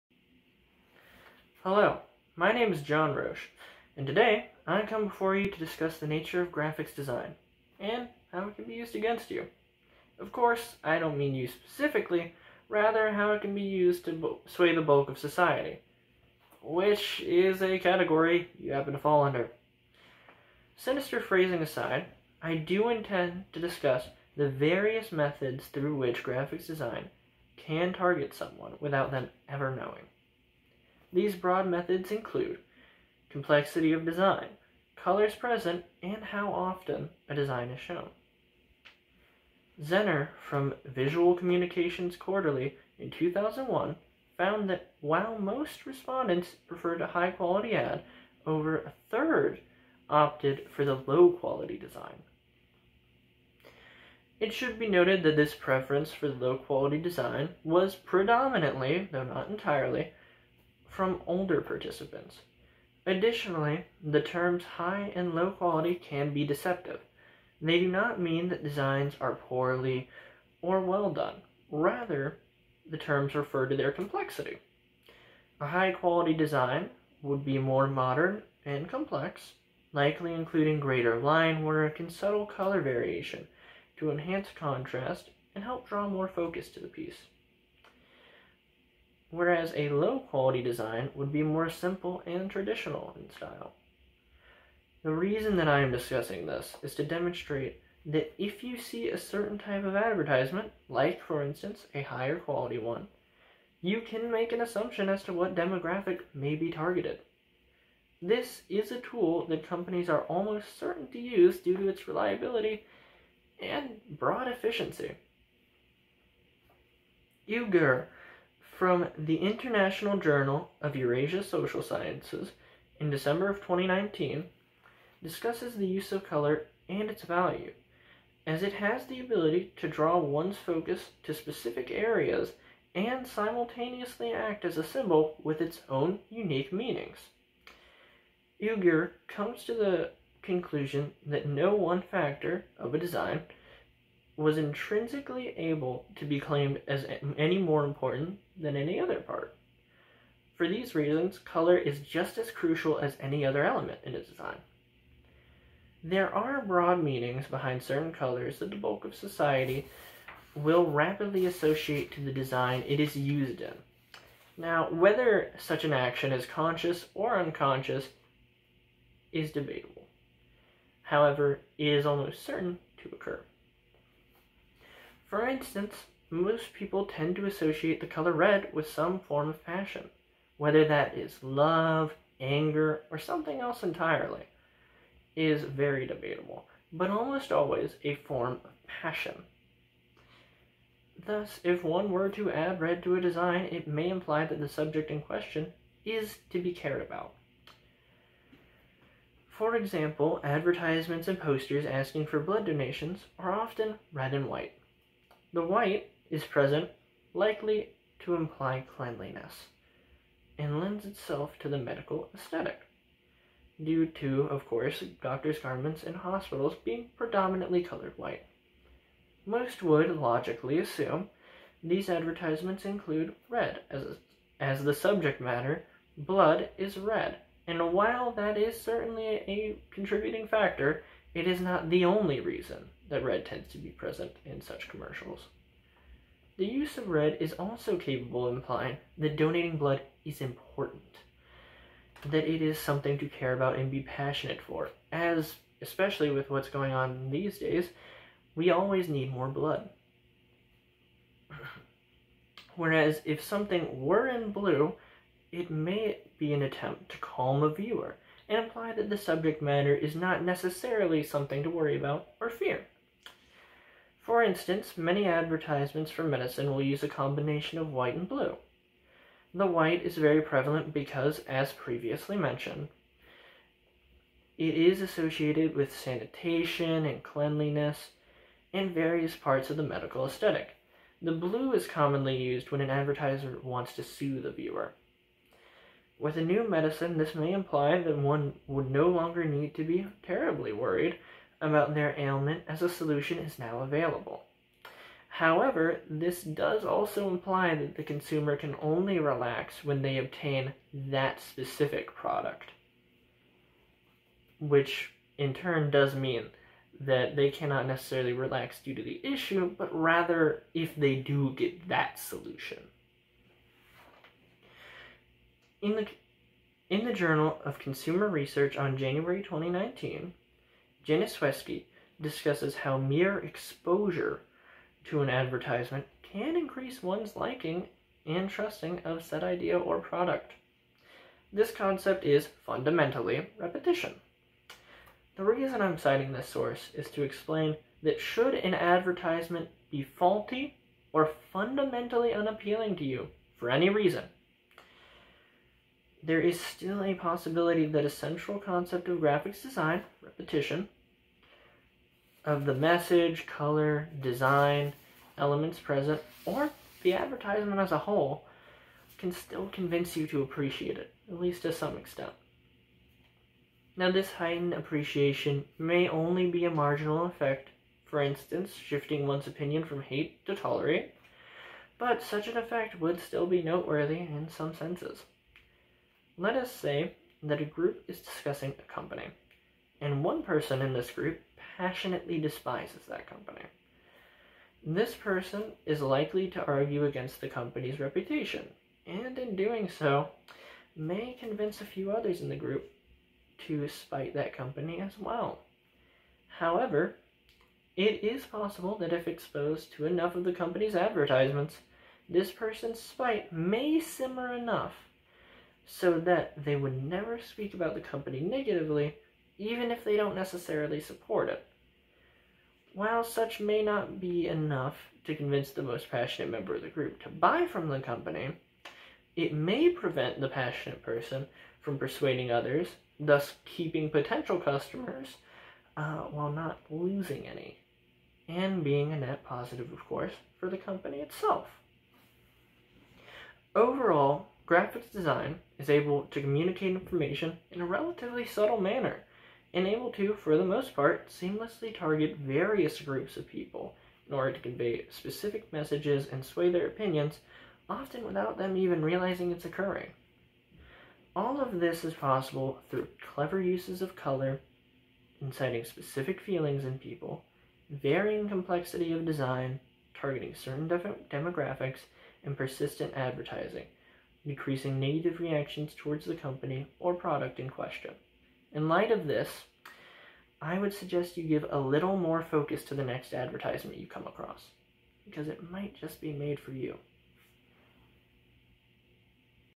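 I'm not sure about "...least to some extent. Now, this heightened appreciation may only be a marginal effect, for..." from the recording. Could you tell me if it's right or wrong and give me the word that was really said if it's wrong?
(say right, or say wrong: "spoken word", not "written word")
right.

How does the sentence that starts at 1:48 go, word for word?
This is a tool that companies are almost certain to use due to its reliability and broad efficiency.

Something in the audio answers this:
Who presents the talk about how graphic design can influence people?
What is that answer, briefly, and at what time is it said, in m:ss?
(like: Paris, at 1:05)
John Roche, at 0:02.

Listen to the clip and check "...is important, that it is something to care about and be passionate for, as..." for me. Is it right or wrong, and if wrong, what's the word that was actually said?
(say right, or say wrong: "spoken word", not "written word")
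right.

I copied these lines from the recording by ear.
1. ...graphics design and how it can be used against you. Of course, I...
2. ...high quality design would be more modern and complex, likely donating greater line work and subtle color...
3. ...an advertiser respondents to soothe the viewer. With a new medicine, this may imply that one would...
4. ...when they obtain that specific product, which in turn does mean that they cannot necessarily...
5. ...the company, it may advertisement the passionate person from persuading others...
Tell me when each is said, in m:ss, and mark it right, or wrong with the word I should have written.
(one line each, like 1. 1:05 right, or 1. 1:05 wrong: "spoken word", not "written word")
1. 0:06 right
2. 1:15 wrong: "including", not "donating"
3. 4:42 wrong: "wants", not "respondents"
4. 4:59 right
5. 6:57 wrong: "prevent", not "advertisement".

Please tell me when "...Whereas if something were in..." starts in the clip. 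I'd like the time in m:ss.
4:12.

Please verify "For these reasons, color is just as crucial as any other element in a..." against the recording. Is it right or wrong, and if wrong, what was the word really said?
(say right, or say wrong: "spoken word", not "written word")
right.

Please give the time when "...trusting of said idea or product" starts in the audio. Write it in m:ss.
5:28.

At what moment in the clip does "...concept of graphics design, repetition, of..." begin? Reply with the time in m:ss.
5:48.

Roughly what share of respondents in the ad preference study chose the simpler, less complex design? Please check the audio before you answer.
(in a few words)
over a third.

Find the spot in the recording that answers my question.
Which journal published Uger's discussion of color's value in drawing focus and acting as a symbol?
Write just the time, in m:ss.
1:59.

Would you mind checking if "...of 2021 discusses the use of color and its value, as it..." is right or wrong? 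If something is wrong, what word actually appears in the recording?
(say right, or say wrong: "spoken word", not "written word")
wrong: "2019", not "2021".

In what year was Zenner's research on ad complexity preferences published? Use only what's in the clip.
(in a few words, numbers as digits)
2001.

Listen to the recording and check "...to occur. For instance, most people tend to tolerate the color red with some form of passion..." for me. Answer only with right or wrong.
wrong.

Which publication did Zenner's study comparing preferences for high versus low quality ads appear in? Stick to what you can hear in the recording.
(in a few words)
Visual Communications Quarterly.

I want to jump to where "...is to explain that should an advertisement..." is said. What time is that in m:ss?
5:36.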